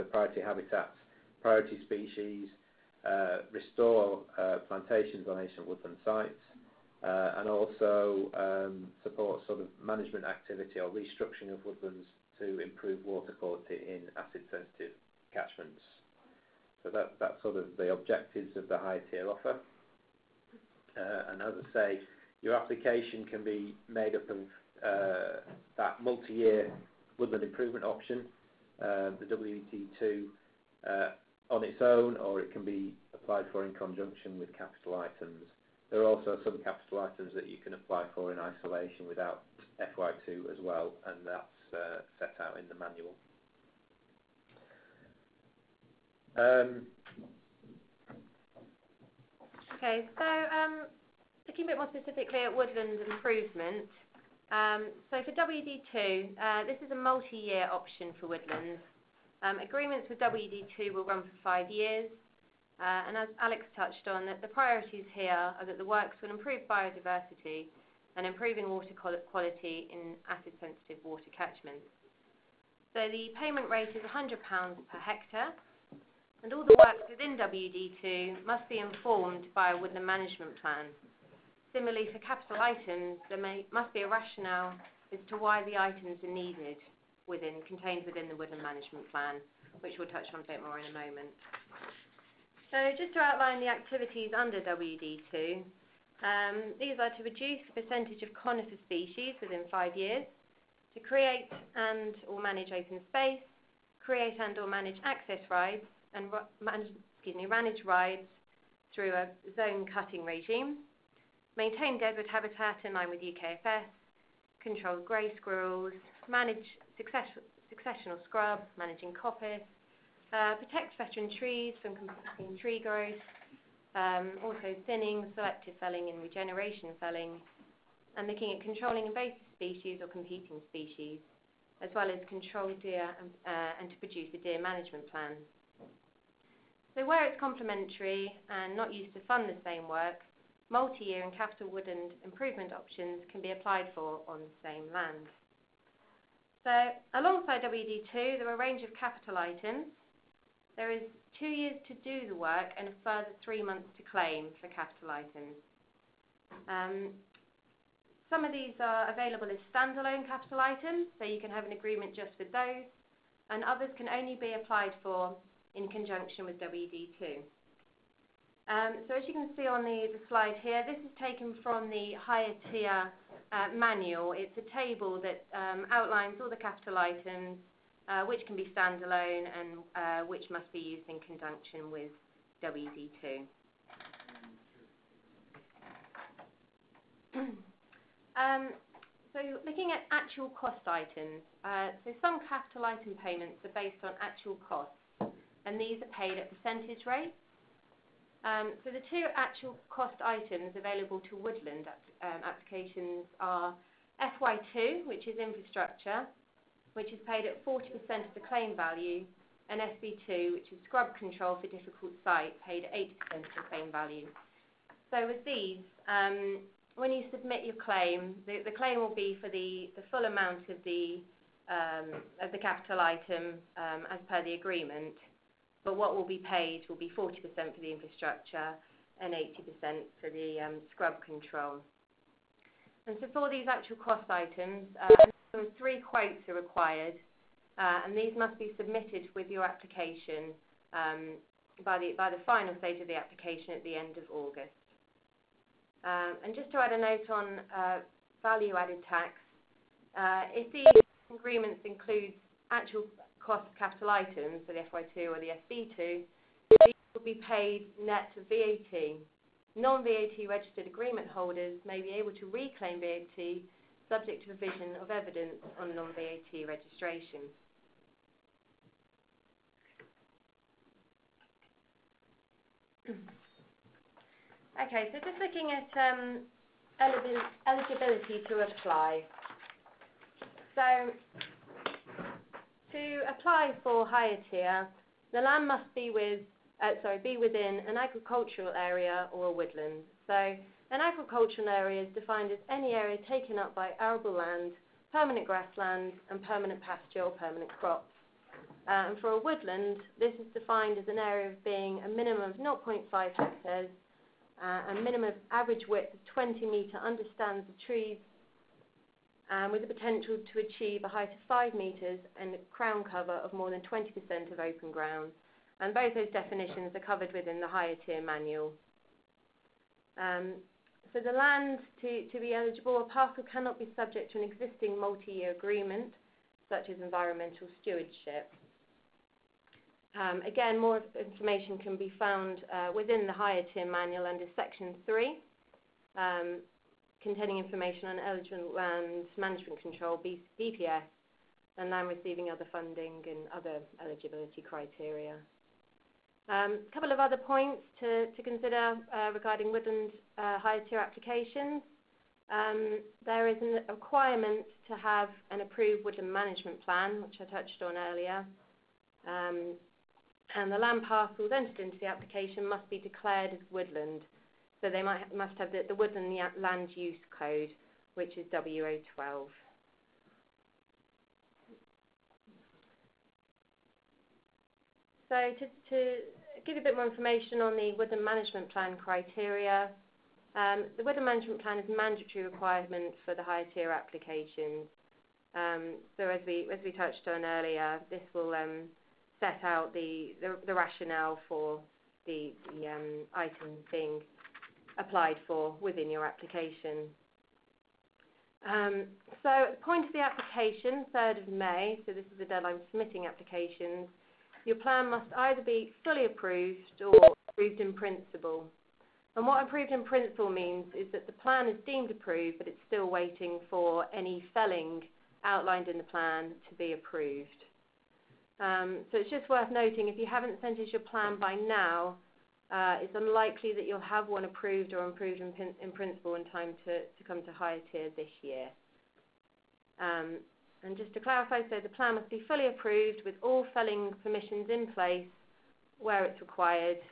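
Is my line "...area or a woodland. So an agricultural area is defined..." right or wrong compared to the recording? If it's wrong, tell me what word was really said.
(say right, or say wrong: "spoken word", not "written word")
right.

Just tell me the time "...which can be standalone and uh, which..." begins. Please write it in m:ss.
2:58.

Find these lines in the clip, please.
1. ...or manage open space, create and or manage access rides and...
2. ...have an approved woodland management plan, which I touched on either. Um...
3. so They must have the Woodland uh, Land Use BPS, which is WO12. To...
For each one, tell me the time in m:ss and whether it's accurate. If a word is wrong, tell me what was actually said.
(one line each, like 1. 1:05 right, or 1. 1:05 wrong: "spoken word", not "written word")
1. 1:42 right
2. 5:54 wrong: "earlier", not "either"
3. 6:04 wrong: "Code", not "BPS".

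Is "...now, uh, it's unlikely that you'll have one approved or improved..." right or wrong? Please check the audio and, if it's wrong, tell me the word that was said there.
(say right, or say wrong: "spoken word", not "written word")
right.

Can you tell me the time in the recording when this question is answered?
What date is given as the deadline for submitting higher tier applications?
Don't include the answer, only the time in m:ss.
6:41.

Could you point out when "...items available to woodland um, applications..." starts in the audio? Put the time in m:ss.
3:20.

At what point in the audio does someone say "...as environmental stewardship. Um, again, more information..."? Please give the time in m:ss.
5:26.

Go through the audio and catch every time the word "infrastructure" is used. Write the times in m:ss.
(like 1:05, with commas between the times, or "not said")
3:25, 3:47.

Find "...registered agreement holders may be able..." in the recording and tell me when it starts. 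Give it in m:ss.
4:20.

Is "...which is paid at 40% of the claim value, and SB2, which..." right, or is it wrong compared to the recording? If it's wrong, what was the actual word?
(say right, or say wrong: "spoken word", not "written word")
right.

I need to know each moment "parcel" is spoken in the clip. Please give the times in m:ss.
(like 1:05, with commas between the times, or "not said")
5:23, 6:01.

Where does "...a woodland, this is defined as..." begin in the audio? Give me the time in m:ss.
4:59.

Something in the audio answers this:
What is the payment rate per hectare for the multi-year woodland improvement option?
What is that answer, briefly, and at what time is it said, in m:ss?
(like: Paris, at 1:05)
100 pounds, at 1:14.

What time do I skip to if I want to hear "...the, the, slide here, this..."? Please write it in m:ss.
2:49.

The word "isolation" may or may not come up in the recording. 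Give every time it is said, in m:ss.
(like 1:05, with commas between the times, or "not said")
0:38.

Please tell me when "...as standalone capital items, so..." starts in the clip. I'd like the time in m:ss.
2:39.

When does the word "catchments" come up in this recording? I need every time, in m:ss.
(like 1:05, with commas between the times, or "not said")
0:15, 1:11.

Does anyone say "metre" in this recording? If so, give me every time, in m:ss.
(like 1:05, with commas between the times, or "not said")
5:06, 5:11.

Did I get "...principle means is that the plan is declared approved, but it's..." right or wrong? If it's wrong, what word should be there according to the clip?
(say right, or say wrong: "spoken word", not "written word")
wrong: "deemed", not "declared".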